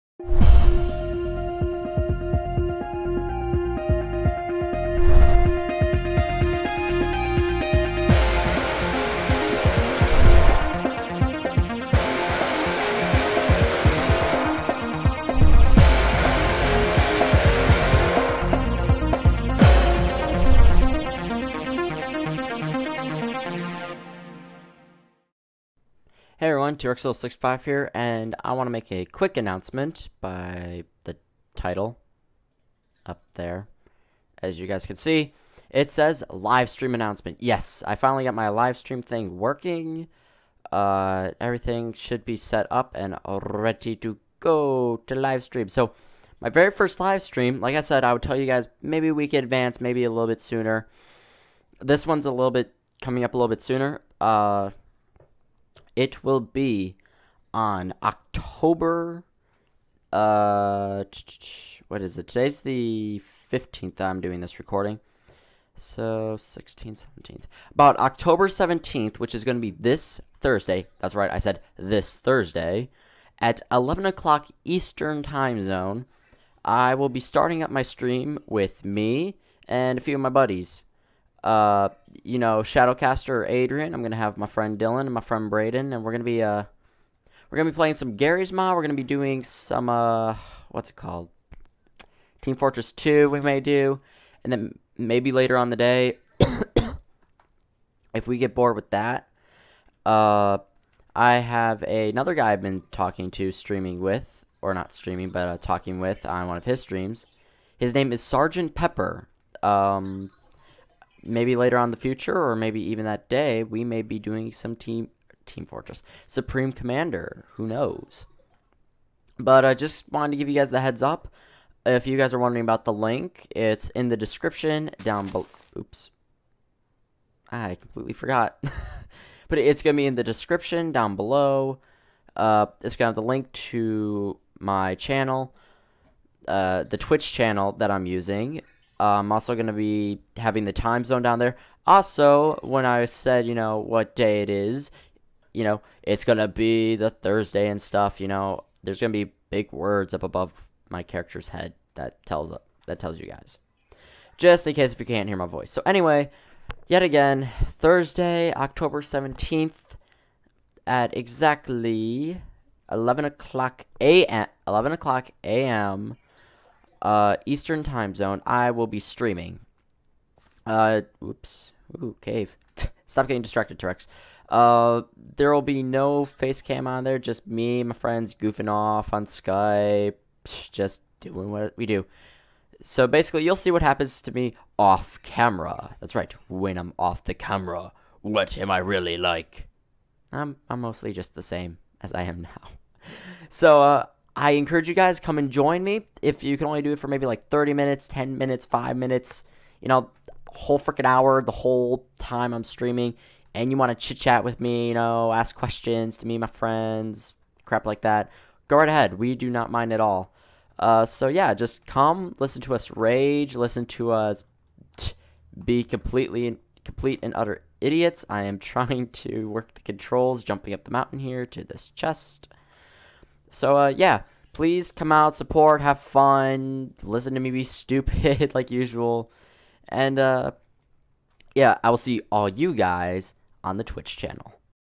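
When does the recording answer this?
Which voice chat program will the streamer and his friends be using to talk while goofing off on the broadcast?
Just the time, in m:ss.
2:59.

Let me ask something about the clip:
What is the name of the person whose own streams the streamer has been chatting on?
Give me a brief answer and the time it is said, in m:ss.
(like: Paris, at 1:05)
Sergeant Pepper, at 1:48.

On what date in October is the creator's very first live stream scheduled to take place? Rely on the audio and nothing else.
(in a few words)
October 17.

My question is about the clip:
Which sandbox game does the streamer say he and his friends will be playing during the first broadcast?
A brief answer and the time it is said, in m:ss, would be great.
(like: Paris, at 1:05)
Garry's Mod, at 1:28.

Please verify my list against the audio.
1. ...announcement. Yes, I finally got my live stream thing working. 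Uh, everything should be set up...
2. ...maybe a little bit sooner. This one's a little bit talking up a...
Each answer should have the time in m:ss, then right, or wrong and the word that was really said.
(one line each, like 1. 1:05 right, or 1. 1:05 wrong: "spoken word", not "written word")
1. 0:36 right
2. 0:49 wrong: "coming", not "talking".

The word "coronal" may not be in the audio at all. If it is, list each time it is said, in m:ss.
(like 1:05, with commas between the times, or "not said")
not said.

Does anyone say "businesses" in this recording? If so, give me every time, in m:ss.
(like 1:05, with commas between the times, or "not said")
not said.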